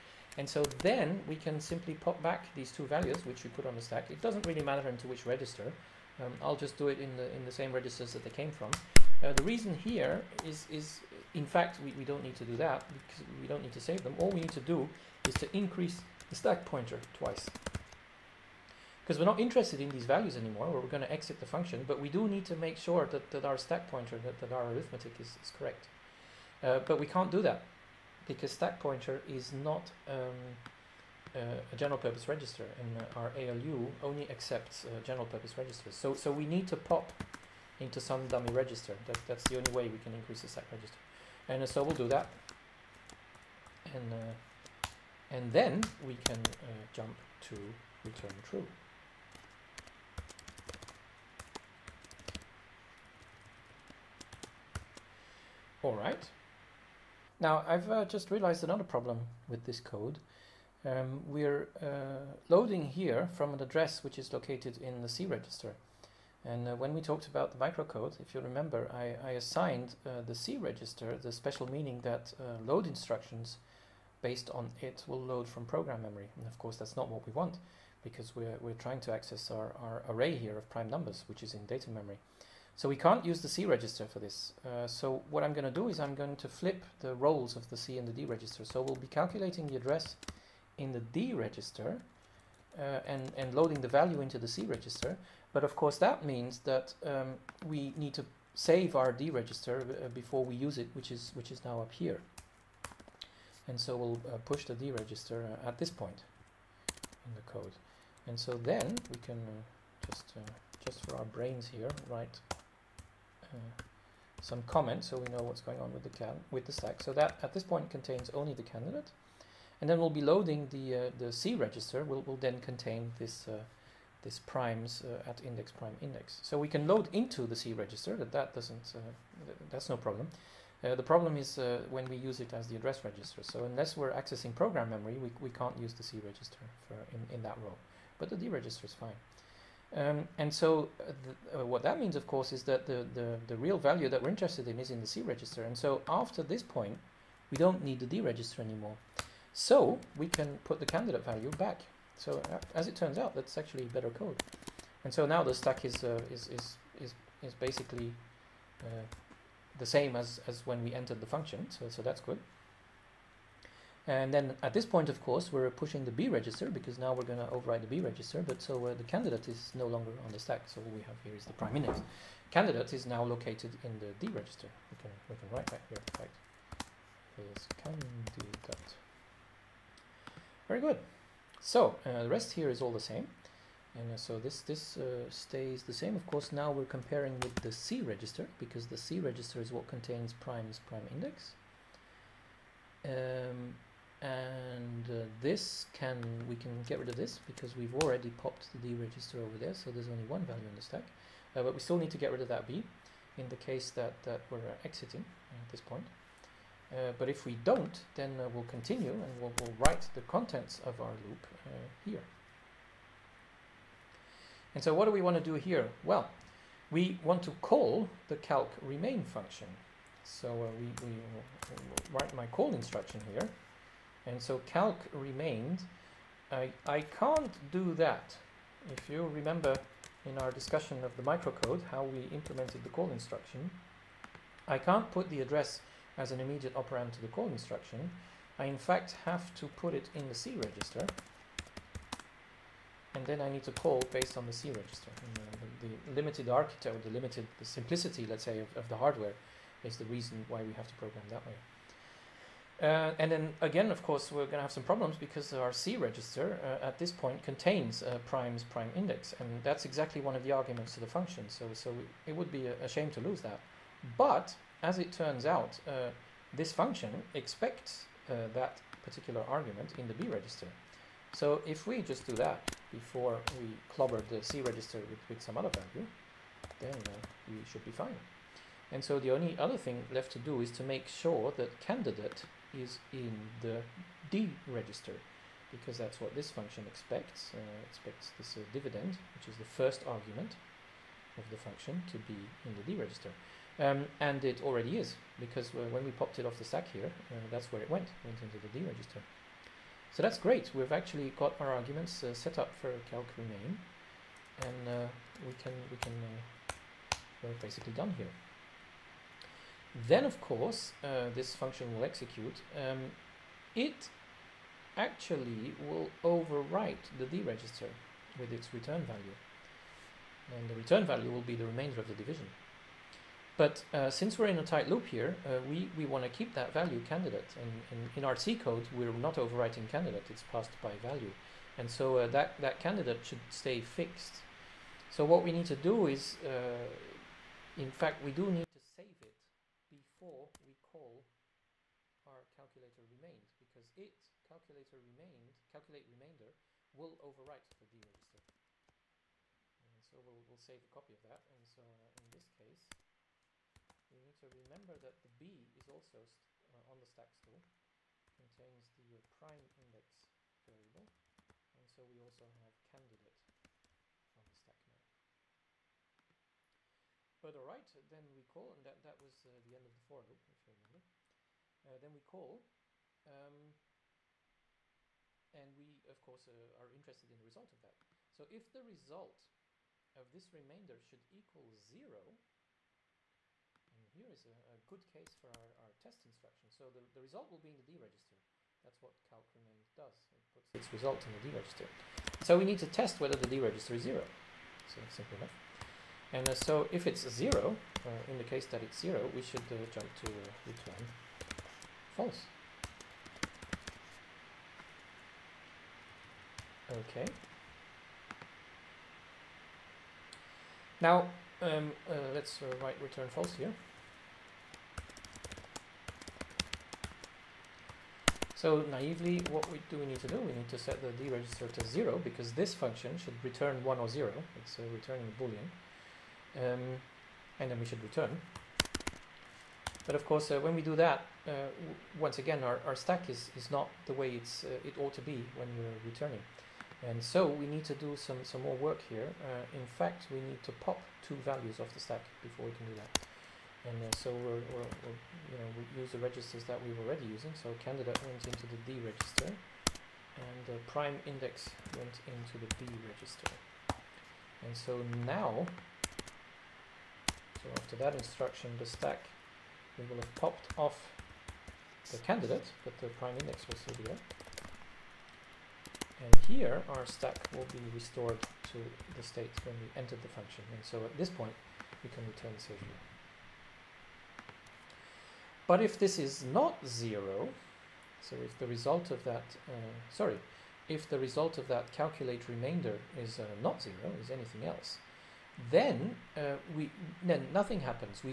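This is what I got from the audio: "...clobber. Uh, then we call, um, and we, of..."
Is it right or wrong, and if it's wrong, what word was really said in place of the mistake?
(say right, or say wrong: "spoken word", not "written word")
wrong: "remember", not "clobber".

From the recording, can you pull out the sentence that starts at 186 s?
Of course, now we're comparing with the C register because the C register is what contains primes prime index.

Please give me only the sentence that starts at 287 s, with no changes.
Uh, expects this uh, dividend, which is the first argument of the function, to be in the D register.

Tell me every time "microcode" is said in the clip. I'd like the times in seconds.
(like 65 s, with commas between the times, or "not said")
67 s, 231 s.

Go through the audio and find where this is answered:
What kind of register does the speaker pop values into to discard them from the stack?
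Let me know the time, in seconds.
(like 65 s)
38 s.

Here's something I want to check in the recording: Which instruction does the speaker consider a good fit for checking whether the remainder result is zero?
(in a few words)
test instruction.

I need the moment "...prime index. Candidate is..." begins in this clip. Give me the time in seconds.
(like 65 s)
171 s.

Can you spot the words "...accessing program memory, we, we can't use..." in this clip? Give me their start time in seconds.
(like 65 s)
134 s.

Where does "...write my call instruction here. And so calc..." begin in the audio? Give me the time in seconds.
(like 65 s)
222 s.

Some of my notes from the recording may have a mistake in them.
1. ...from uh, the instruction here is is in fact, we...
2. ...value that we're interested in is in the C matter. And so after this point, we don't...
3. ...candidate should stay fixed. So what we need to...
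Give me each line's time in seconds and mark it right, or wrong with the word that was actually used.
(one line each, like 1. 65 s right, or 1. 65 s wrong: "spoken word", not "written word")
1. 8 s wrong: "reason", not "instruction"
2. 143 s wrong: "register", not "matter"
3. 332 s right.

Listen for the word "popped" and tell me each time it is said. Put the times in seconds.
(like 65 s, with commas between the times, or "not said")
198 s, 296 s, 460 s.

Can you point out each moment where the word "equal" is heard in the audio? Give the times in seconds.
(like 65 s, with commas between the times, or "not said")
381 s.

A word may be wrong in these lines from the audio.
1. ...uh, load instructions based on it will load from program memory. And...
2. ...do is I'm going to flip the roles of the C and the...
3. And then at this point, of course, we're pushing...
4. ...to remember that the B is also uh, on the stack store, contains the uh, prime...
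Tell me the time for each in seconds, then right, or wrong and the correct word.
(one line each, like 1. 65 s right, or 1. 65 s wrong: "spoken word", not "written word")
1. 72 s right
2. 85 s right
3. 164 s right
4. 354 s right.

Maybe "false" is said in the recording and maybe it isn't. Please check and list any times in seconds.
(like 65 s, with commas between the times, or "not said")
402 s, 413 s.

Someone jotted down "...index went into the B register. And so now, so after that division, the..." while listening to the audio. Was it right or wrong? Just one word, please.
wrong.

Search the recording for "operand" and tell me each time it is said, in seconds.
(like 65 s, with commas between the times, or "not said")
236 s.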